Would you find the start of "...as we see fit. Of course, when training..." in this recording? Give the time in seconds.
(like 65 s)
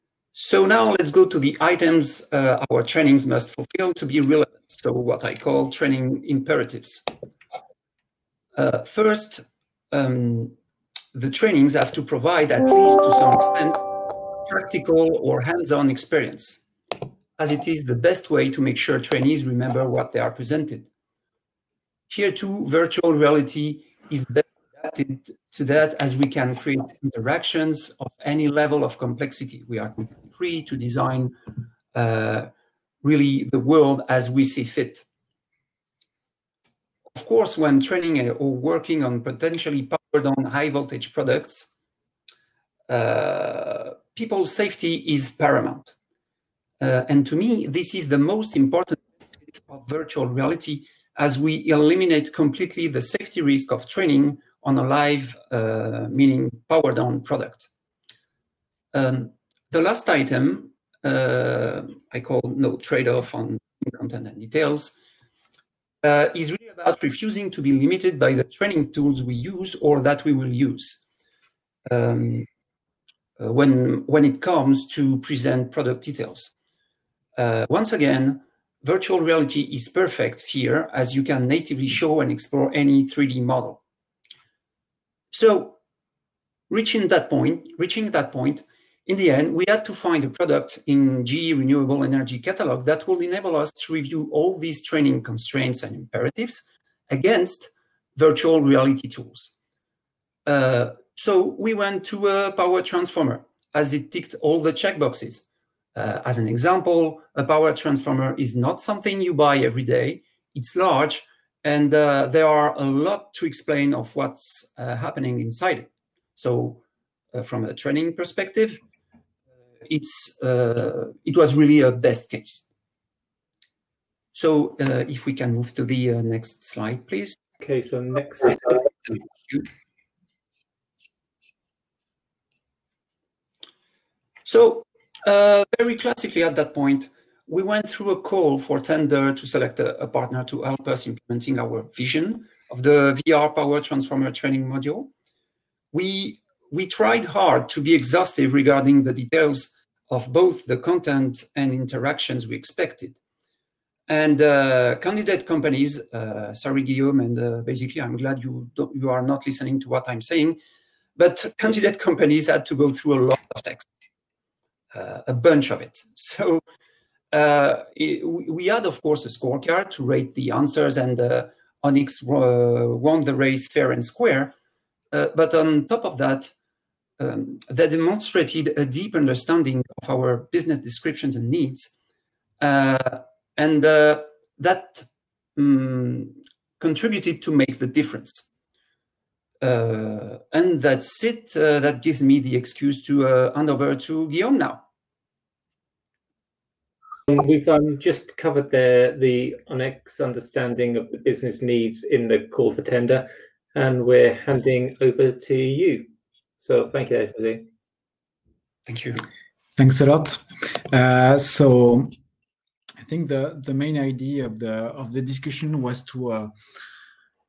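34 s.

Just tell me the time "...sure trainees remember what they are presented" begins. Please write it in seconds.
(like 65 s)
18 s.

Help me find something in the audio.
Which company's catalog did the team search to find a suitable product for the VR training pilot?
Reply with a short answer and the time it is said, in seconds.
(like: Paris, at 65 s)
GE Renewable Energy, at 91 s.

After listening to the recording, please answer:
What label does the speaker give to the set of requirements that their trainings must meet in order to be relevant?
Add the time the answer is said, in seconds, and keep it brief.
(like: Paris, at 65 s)
Training imperatives, at 5 s.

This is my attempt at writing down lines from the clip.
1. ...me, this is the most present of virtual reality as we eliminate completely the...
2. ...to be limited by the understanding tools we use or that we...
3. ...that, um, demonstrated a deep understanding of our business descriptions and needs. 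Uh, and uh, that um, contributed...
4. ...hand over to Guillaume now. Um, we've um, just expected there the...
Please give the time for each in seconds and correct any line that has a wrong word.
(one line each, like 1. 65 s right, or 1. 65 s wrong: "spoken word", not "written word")
1. 47 s wrong: "important", not "present"
2. 67 s wrong: "training", not "understanding"
3. 176 s right
4. 193 s wrong: "covered", not "expected".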